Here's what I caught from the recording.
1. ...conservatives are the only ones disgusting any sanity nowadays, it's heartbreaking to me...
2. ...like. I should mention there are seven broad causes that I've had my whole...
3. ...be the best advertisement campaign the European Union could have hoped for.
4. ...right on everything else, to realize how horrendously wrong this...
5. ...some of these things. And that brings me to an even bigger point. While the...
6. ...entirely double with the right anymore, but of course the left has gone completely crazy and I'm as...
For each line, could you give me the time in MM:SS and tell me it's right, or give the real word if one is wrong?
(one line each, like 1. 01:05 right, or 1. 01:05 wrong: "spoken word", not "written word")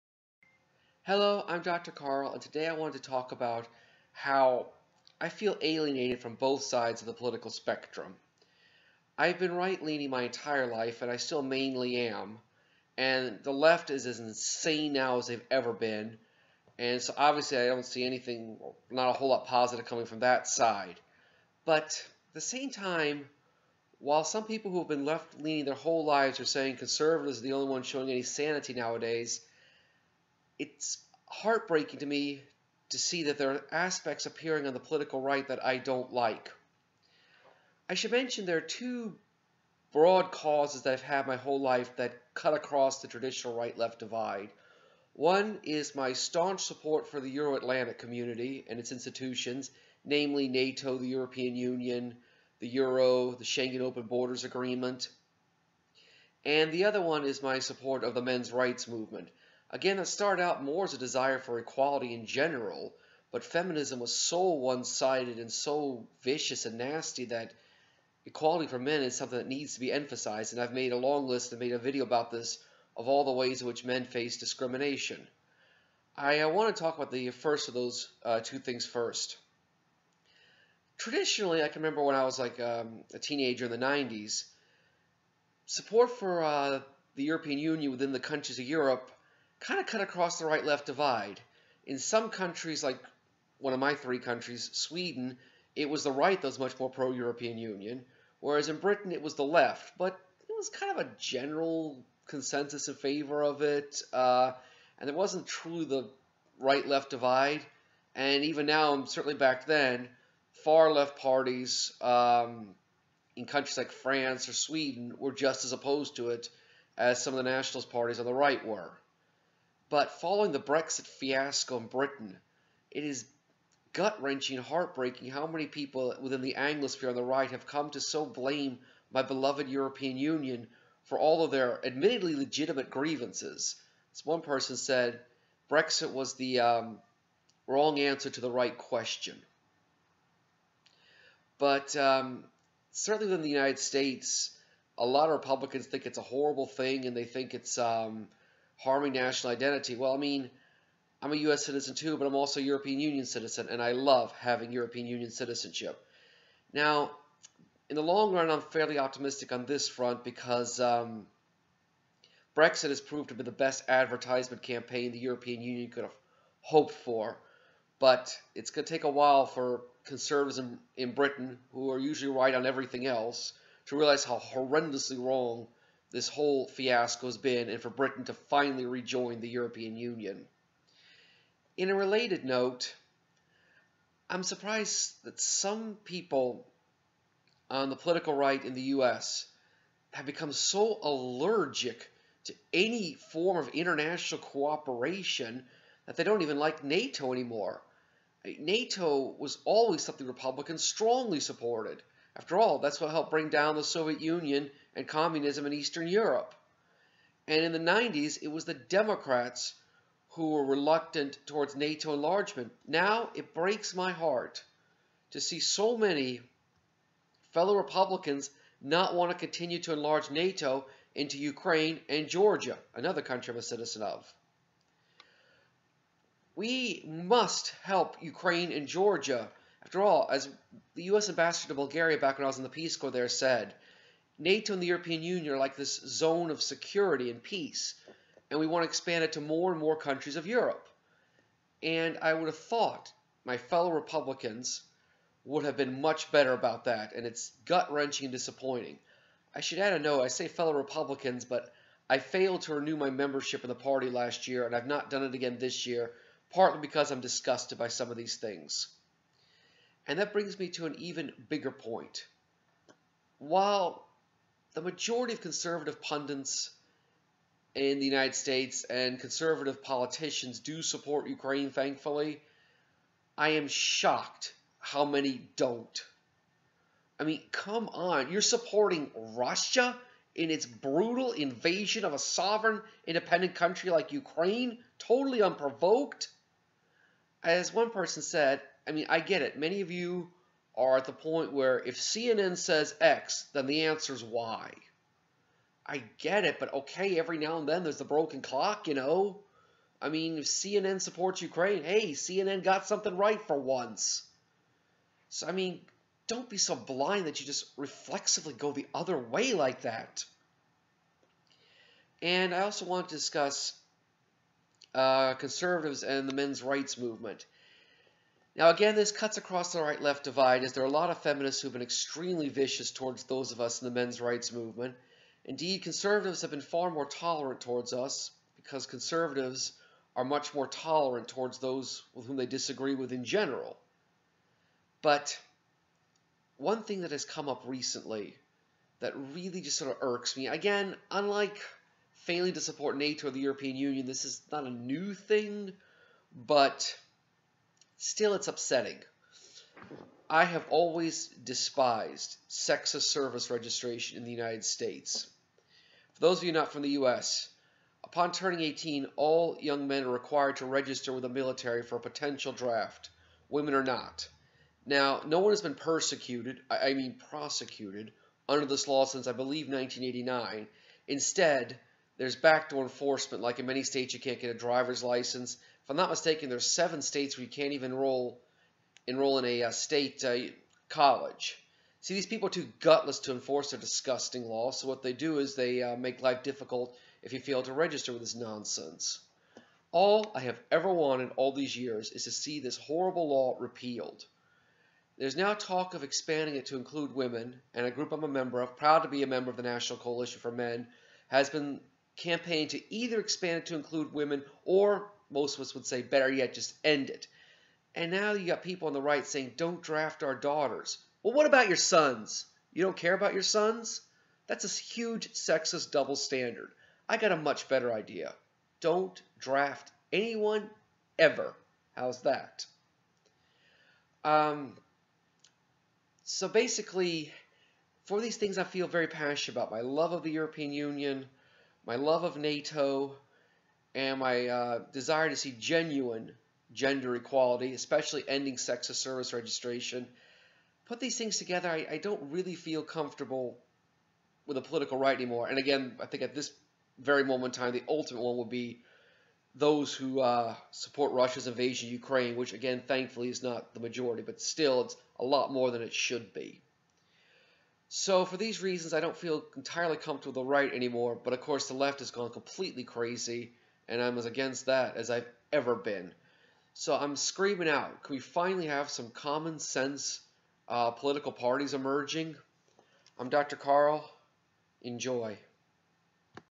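1. 00:26 wrong: "showing", not "disgusting"
2. 00:36 wrong: "two", not "seven"
3. 02:43 right
4. 02:52 right
5. 04:17 right
6. 07:39 wrong: "comfortable", not "double".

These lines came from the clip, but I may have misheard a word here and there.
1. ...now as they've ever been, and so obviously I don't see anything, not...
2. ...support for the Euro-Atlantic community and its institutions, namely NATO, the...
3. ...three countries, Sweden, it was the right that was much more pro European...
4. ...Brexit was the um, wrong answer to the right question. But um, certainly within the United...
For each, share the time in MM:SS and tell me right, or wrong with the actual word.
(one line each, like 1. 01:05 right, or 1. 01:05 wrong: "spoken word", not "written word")
1. 00:14 right
2. 00:46 right
3. 01:33 right
4. 02:15 right.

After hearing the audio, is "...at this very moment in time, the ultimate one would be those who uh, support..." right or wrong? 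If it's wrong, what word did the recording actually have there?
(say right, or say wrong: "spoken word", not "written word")
right.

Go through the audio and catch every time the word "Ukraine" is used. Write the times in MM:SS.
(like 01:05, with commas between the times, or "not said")
03:41, 03:48, 04:31, 04:44, 05:01, 07:31.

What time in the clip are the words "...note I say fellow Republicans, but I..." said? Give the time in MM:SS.
04:09.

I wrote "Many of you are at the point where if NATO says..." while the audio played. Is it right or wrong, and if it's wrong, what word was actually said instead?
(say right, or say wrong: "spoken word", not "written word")
wrong: "CNN", not "NATO".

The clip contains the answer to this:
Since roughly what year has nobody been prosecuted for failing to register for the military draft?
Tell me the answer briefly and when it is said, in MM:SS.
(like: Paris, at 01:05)
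1989, at 06:09.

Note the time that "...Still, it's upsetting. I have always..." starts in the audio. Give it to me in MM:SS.
05:48.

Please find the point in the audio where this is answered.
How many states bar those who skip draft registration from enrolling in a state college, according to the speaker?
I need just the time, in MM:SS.
06:16.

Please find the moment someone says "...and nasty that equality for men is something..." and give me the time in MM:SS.
01:06.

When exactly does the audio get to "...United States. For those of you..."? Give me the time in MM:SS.
05:54.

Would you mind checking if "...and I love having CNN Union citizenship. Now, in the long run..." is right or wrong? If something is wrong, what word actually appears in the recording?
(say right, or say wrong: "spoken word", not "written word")
wrong: "European", not "CNN".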